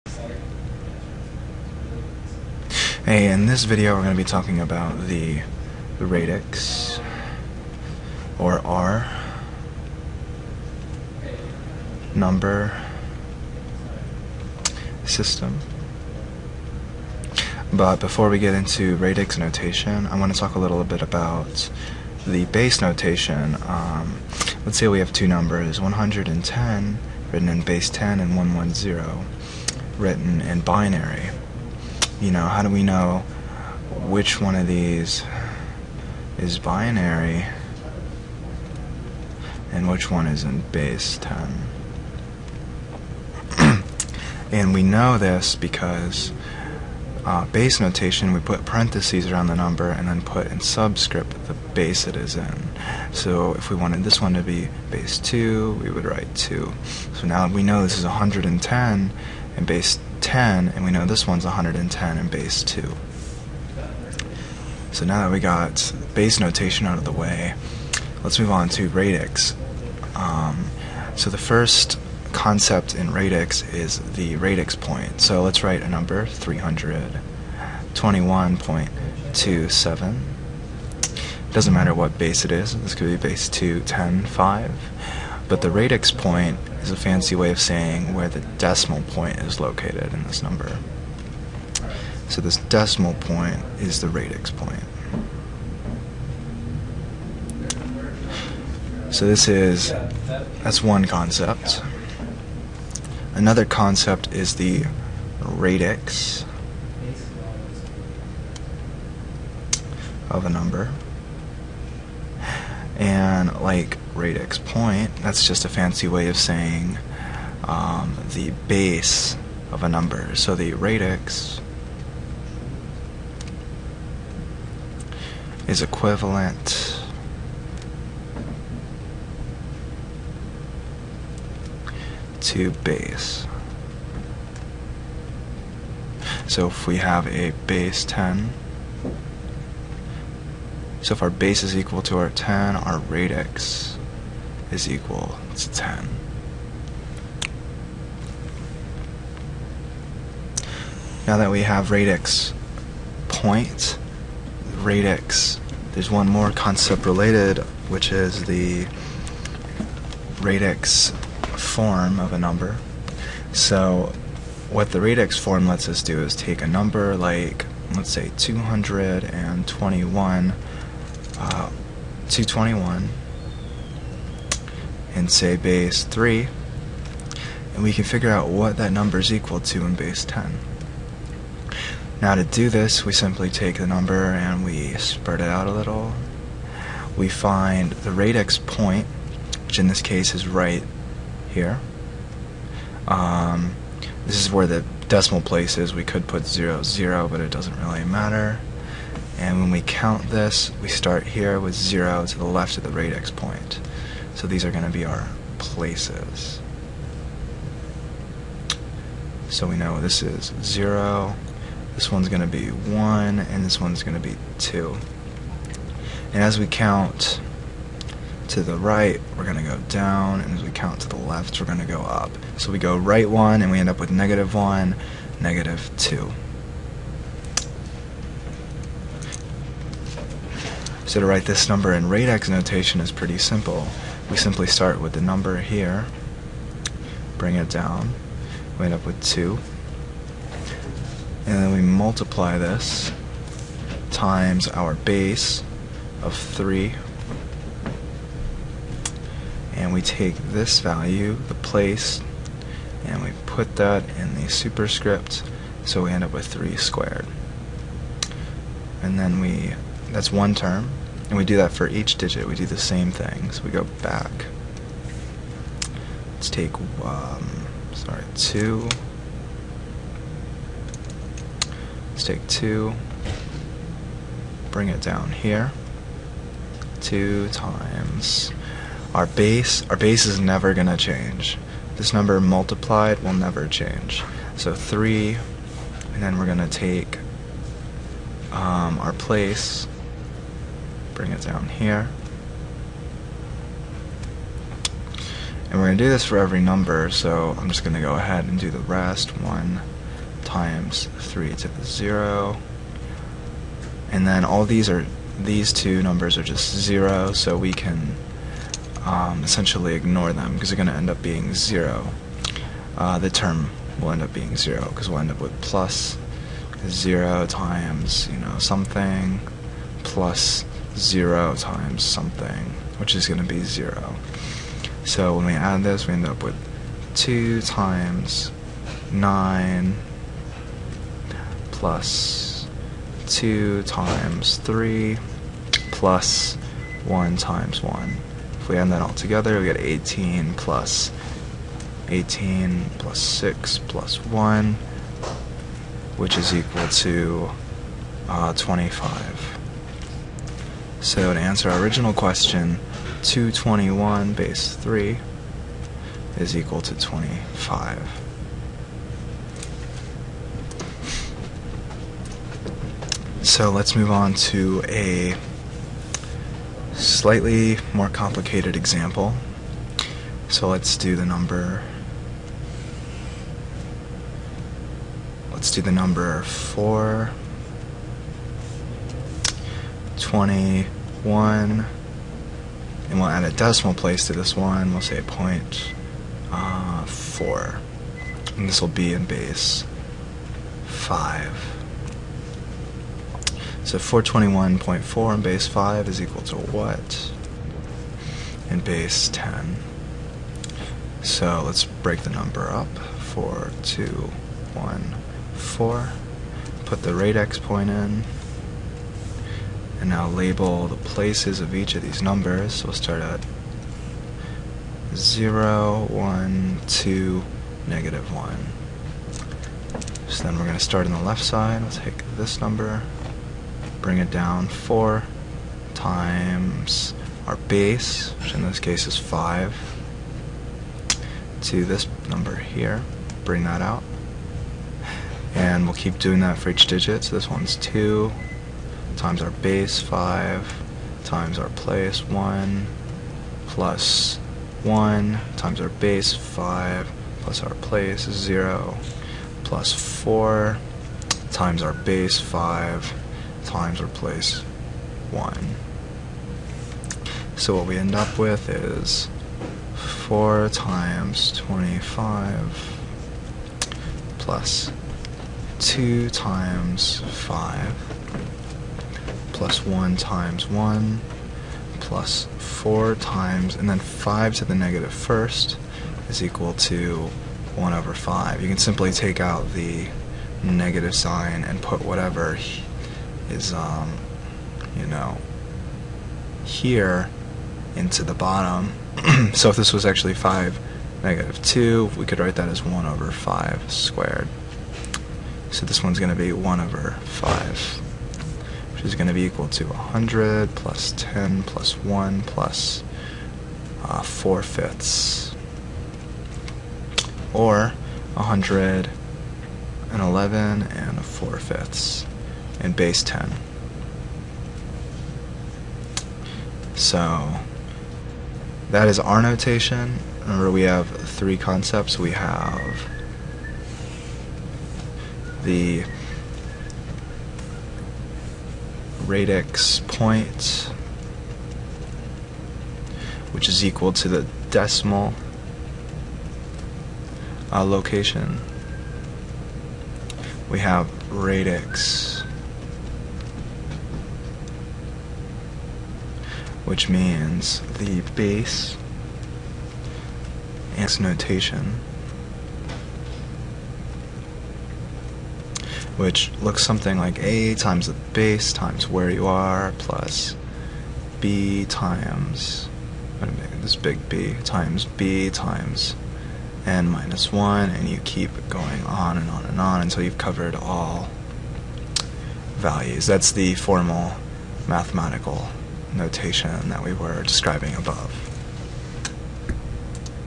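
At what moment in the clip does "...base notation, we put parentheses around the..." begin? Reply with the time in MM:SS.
00:47.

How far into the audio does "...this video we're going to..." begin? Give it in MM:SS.
00:03.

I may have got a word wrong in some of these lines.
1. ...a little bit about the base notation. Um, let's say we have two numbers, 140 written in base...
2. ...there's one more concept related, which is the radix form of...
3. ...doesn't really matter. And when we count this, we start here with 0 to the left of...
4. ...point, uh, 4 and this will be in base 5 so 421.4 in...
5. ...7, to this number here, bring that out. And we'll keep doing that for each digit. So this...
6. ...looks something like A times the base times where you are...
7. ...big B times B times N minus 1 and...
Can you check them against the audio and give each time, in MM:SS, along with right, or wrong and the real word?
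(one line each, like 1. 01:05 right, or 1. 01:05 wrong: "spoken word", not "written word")
1. 00:20 wrong: "110", not "140"
2. 02:35 right
3. 03:17 right
4. 06:25 right
5. 07:09 wrong: "5", not "7"
6. 09:16 right
7. 09:23 right.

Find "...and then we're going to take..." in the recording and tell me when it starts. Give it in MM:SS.
04:46.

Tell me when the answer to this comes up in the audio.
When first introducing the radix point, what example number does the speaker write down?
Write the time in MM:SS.
01:16.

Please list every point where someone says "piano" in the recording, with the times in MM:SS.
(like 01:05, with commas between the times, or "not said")
not said.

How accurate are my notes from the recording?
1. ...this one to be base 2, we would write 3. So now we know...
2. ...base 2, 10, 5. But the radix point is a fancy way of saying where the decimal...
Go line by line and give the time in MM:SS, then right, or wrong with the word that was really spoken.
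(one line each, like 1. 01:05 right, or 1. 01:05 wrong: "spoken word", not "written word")
1. 00:54 wrong: "2", not "3"
2. 01:23 right.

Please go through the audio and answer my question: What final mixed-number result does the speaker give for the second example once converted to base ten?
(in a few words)
111 and 4/5.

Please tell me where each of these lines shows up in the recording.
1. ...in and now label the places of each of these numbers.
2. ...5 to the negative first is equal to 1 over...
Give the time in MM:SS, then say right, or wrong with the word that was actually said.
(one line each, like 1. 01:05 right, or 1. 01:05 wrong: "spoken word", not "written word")
1. 06:47 right
2. 07:53 right.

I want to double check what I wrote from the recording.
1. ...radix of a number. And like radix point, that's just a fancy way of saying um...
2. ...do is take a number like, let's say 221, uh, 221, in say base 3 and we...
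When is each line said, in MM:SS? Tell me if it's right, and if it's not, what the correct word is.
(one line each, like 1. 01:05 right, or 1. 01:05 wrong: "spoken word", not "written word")
1. 01:45 right
2. 02:46 right.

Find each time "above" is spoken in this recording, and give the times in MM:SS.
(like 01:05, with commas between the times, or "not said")
09:37.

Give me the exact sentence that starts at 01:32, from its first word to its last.
So this decimal point is the radix point.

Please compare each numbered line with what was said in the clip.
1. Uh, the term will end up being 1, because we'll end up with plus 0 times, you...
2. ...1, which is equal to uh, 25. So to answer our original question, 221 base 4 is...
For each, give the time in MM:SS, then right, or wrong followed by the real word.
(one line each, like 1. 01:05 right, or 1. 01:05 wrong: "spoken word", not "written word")
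1. 05:12 wrong: "0", not "1"
2. 05:44 wrong: "3", not "4".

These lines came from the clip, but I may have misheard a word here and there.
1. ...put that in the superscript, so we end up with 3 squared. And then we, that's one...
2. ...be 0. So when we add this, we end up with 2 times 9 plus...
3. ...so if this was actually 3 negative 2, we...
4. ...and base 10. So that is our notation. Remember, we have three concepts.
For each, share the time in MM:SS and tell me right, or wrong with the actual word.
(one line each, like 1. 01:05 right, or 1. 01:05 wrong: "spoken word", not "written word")
1. 04:13 right
2. 05:23 right
3. 08:09 wrong: "5", not "3"
4. 08:32 right.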